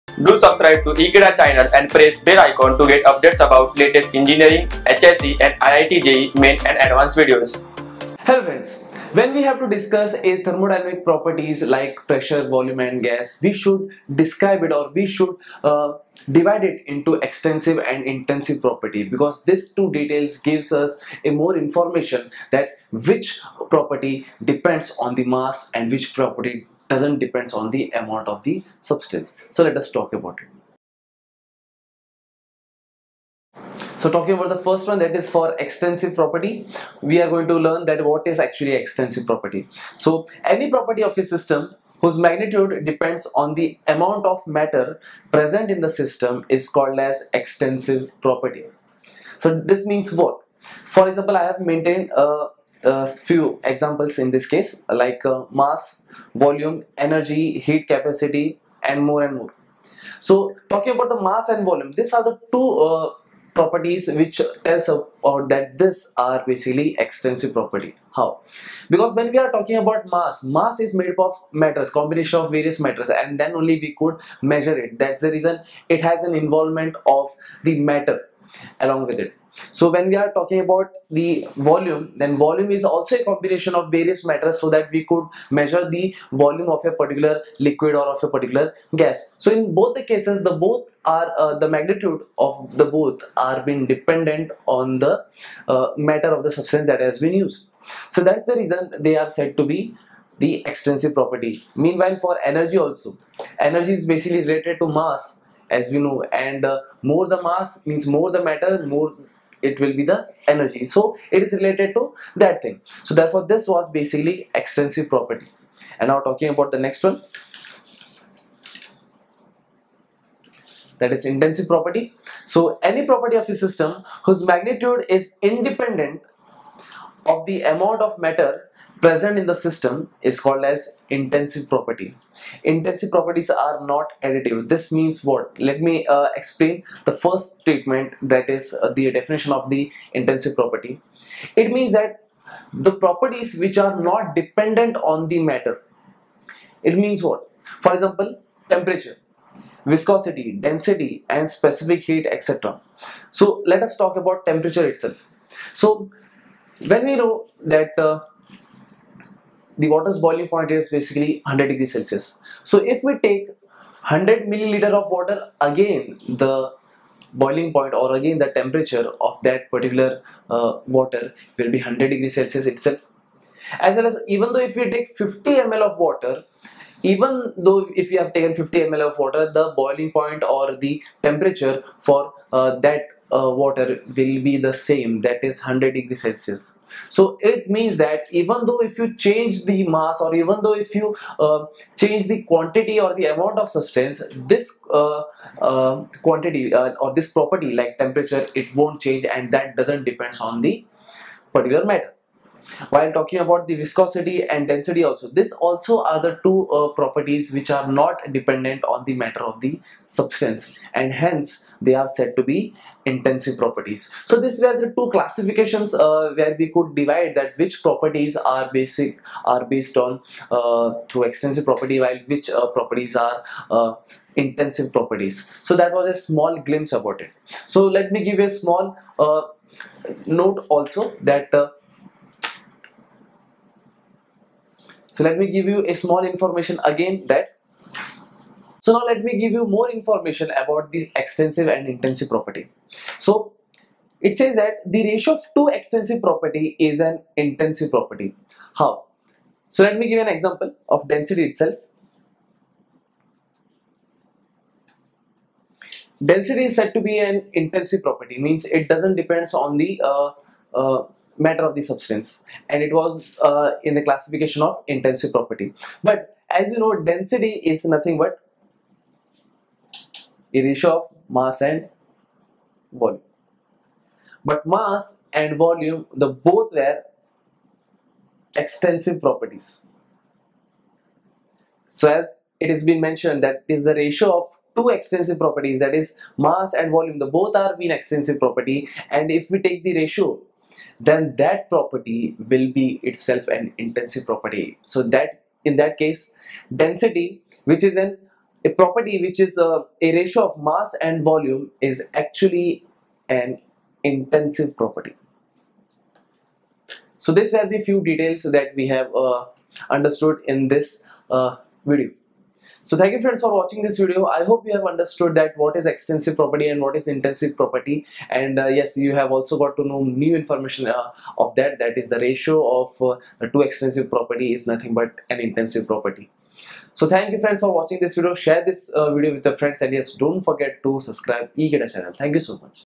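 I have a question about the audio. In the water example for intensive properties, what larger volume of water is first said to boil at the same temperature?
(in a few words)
100 milliliter.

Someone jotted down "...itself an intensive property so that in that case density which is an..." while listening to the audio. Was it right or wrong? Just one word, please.
right.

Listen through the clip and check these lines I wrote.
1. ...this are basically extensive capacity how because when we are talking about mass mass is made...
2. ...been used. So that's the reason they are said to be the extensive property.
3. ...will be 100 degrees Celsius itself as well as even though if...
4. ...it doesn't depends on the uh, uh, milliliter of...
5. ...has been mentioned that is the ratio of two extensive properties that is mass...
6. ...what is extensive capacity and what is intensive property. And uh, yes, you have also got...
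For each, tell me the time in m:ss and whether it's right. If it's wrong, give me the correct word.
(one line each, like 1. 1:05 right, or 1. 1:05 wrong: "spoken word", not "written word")
1. 1:05 wrong: "property", not "capacity"
2. 1:37 right
3. 2:51 right
4. 4:18 wrong: "matter", not "milliliter"
5. 4:42 right
6. 5:15 wrong: "property", not "capacity".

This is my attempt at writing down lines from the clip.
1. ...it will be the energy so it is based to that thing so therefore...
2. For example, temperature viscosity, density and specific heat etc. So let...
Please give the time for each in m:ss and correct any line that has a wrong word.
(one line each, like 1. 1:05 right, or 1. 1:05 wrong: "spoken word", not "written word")
1. 1:49 wrong: "related", not "based"
2. 2:27 right.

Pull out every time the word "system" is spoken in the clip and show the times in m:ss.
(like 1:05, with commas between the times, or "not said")
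0:41, 0:45, 2:03, 2:09.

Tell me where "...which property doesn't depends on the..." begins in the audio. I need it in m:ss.
0:25.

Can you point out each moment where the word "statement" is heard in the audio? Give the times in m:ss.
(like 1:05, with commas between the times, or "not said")
2:17.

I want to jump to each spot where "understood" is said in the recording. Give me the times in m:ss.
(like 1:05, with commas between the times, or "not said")
5:09, 5:14.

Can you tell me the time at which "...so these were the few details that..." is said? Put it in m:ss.
5:07.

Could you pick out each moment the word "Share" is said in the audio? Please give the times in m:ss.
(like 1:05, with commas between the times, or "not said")
5:28.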